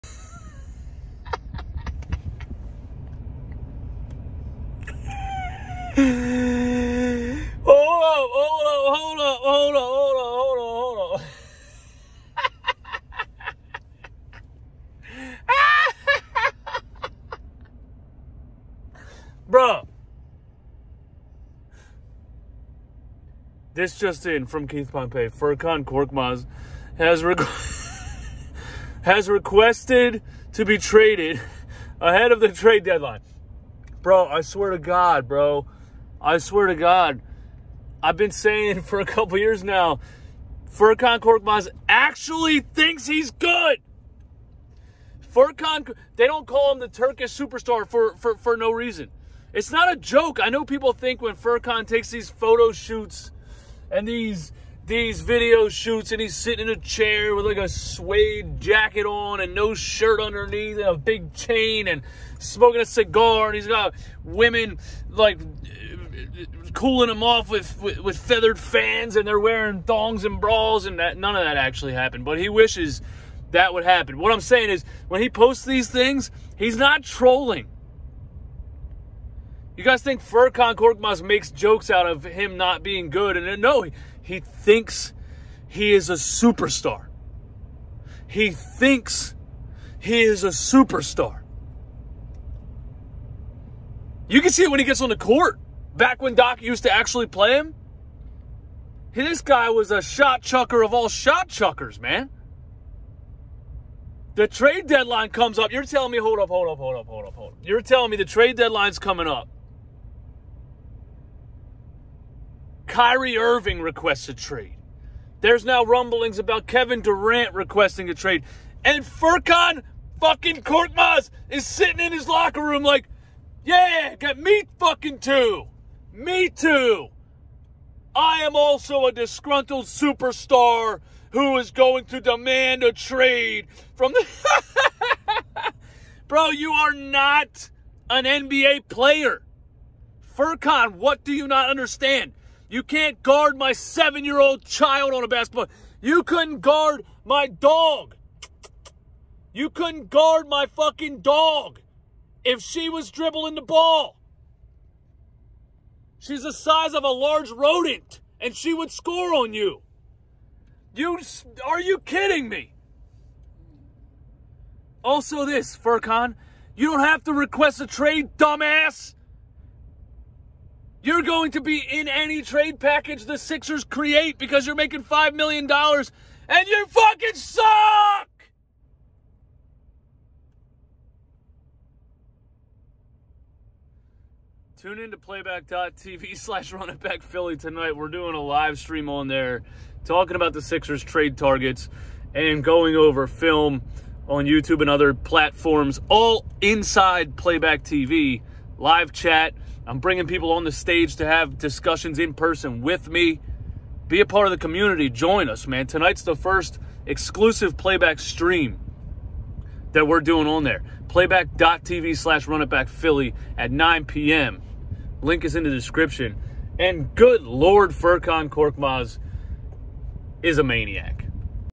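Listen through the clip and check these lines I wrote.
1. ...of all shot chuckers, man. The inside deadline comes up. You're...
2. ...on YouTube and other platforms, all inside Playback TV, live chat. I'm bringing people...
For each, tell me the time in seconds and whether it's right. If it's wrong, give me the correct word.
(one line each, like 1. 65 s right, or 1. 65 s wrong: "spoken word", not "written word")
1. 100 s wrong: "trade", not "inside"
2. 194 s right.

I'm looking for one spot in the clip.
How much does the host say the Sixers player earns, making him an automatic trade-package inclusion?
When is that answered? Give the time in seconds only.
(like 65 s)
175 s.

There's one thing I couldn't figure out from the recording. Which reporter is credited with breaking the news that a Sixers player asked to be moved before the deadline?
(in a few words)
Keith Pompey.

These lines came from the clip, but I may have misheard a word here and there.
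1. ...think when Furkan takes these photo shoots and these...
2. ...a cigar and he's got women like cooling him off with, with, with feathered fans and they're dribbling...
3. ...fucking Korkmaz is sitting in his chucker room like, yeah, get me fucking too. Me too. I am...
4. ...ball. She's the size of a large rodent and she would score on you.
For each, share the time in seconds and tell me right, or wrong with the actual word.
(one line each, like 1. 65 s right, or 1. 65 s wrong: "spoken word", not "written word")
1. 50 s right
2. 62 s wrong: "wearing", not "dribbling"
3. 120 s wrong: "locker", not "chucker"
4. 153 s right.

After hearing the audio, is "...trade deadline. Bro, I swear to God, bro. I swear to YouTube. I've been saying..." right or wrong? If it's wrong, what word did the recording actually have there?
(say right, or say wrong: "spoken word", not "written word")
wrong: "God", not "YouTube".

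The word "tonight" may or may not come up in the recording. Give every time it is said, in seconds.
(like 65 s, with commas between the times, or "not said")
187 s, 205 s.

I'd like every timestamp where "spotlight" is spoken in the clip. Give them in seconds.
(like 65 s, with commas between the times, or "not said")
not said.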